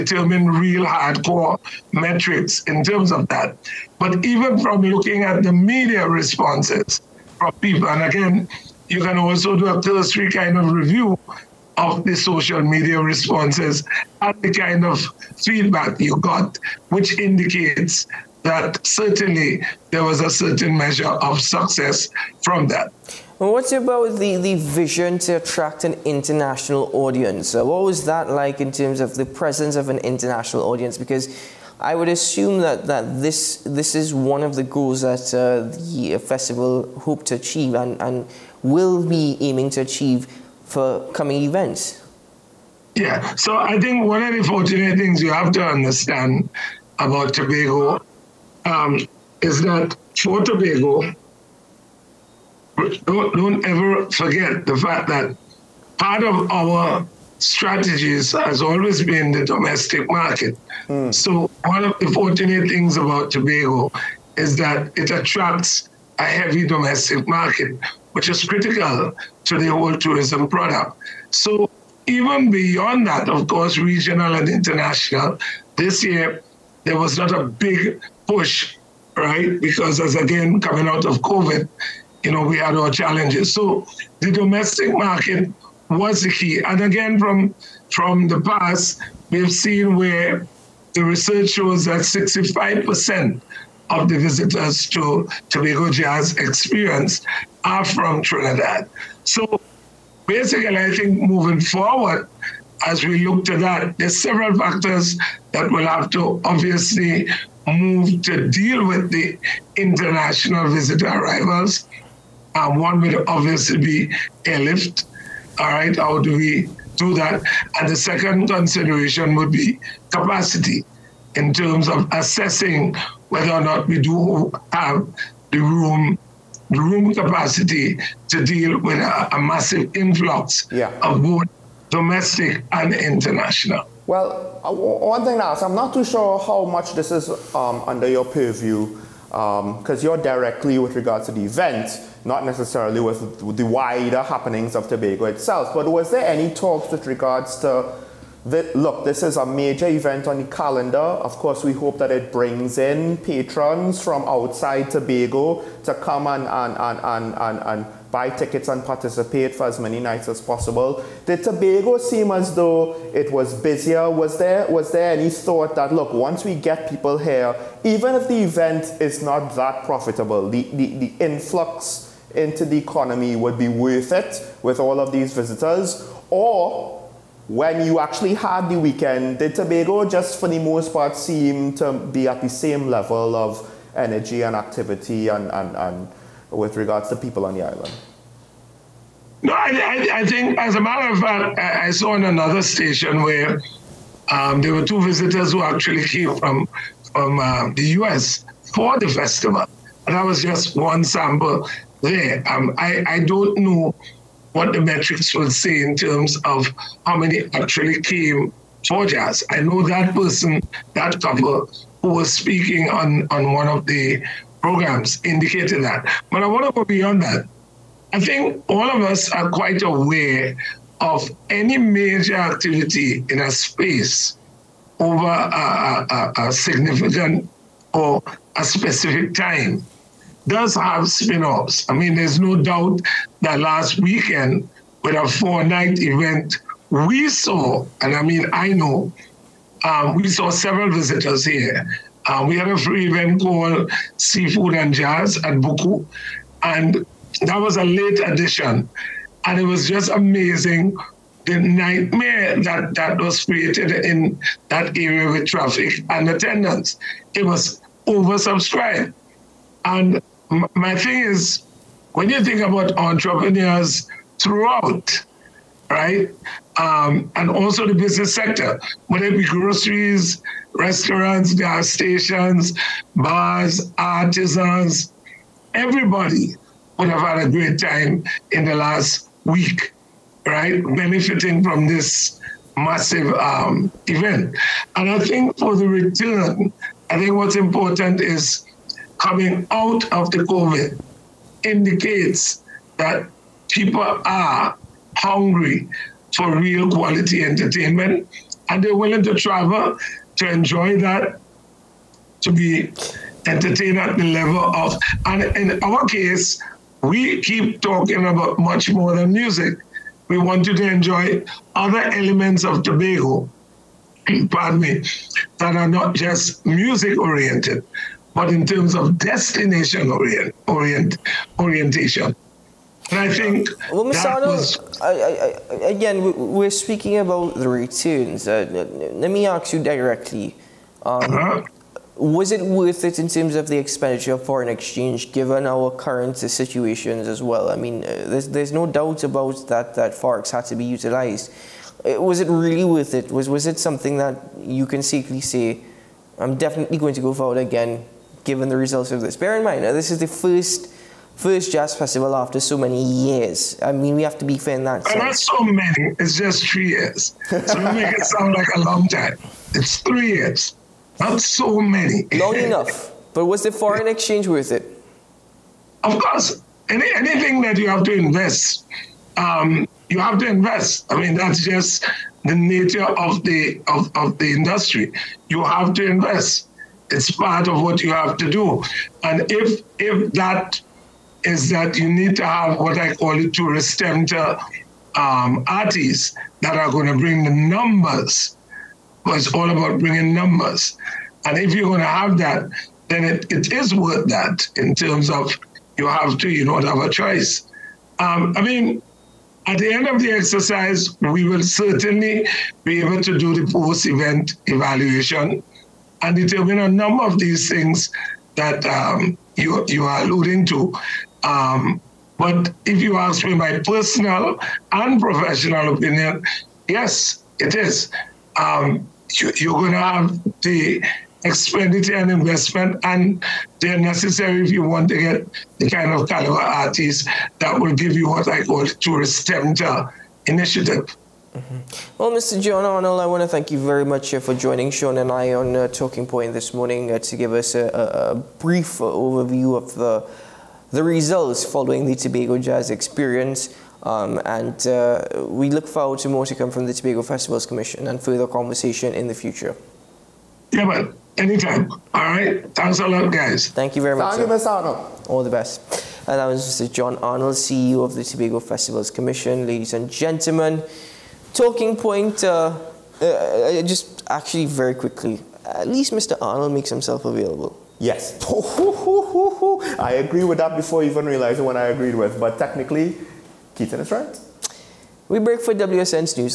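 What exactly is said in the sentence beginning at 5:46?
I'm definitely going to go forward again given the results of this.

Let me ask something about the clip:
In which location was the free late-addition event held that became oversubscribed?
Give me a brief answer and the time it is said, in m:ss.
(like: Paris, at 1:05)
Buccoo, at 4:05.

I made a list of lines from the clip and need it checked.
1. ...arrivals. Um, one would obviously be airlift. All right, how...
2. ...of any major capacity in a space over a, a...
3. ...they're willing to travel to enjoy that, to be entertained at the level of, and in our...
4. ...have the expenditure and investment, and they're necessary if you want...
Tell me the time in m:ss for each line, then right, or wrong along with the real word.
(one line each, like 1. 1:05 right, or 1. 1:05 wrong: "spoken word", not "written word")
1. 1:51 right
2. 3:40 wrong: "activity", not "capacity"
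3. 4:58 right
4. 6:59 right.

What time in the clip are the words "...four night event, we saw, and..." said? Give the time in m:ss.
3:55.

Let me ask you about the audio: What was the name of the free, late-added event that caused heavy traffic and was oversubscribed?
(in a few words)
Seafood and Jazz.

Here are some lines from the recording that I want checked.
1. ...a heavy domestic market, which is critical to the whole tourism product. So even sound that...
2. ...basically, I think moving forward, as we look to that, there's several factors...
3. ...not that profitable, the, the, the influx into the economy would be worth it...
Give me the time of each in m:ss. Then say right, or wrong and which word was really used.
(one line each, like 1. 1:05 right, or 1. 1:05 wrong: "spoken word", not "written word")
1. 1:06 wrong: "beyond", not "sound"
2. 1:40 right
3. 2:49 right.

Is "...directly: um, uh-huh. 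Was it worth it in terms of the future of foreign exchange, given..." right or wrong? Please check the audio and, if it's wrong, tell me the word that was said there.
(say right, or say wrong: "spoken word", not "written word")
wrong: "expenditure", not "future".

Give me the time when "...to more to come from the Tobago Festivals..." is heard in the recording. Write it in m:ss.
7:26.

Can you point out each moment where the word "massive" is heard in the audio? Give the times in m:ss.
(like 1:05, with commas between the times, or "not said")
2:09, 4:42.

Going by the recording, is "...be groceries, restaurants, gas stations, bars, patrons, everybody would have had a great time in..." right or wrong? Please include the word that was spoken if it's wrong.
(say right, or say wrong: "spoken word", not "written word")
wrong: "artisans", not "patrons".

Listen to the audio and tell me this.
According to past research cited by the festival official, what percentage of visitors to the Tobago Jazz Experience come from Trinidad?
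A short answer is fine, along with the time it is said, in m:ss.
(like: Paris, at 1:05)
65%, at 1:32.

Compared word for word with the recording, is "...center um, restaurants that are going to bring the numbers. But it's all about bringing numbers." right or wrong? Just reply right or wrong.
wrong.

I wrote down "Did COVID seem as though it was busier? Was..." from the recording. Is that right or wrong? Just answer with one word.
wrong.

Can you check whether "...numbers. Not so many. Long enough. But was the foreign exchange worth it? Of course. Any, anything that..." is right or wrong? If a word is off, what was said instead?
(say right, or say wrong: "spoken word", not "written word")
wrong: "years", not "numbers".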